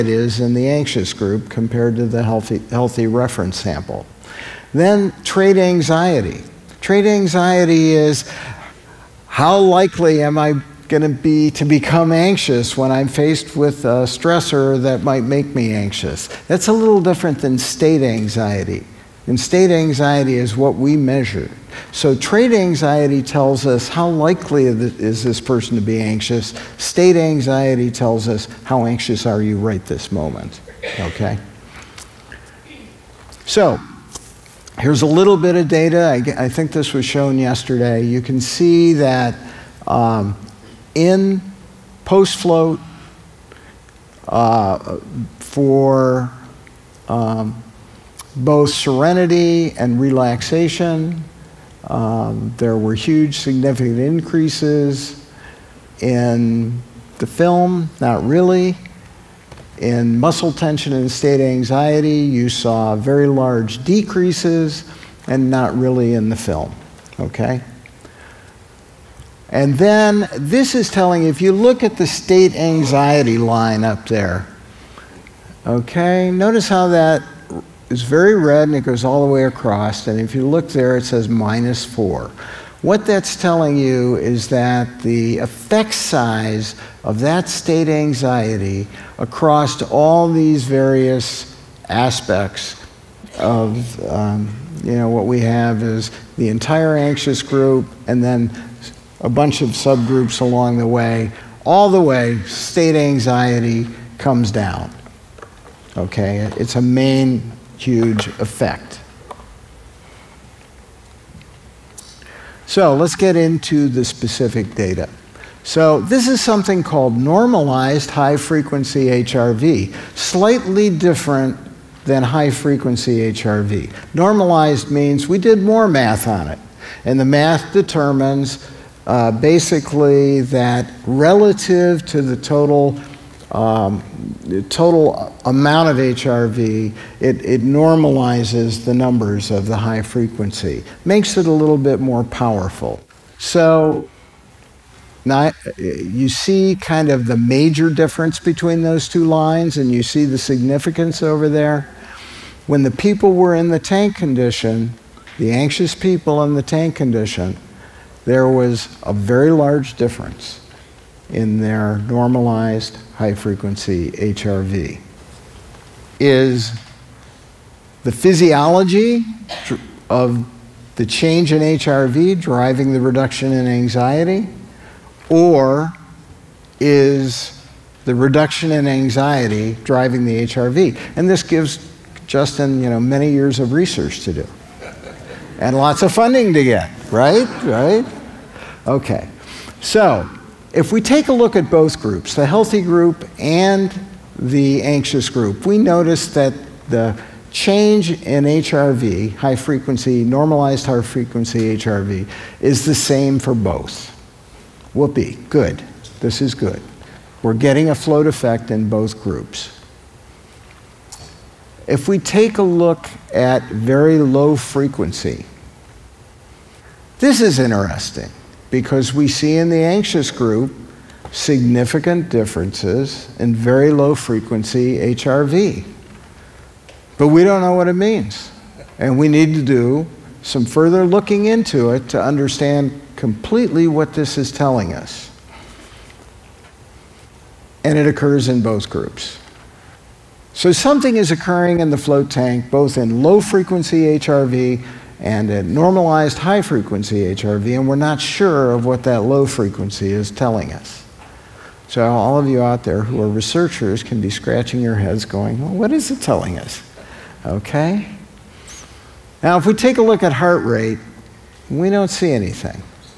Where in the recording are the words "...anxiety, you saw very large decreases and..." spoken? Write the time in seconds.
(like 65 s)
61 s.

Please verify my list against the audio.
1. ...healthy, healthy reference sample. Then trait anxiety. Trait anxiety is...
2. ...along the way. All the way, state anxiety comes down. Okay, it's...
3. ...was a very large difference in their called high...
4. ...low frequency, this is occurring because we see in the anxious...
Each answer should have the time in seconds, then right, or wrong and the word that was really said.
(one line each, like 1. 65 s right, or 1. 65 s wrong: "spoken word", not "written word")
1. 2 s right
2. 100 s right
3. 158 s wrong: "normalized", not "called"
4. 214 s wrong: "interesting", not "occurring".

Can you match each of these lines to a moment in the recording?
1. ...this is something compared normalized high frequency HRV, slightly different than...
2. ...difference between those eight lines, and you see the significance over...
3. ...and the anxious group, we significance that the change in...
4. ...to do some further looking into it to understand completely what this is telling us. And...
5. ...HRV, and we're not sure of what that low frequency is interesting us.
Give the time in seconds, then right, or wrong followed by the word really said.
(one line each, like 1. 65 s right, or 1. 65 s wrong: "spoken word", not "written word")
1. 116 s wrong: "called", not "compared"
2. 147 s wrong: "two", not "eight"
3. 193 s wrong: "notice", not "significance"
4. 229 s right
5. 247 s wrong: "telling", not "interesting".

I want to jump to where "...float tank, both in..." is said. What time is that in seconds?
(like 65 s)
241 s.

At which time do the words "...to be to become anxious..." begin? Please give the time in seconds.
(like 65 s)
11 s.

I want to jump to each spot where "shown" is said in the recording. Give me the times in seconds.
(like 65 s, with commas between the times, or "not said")
37 s.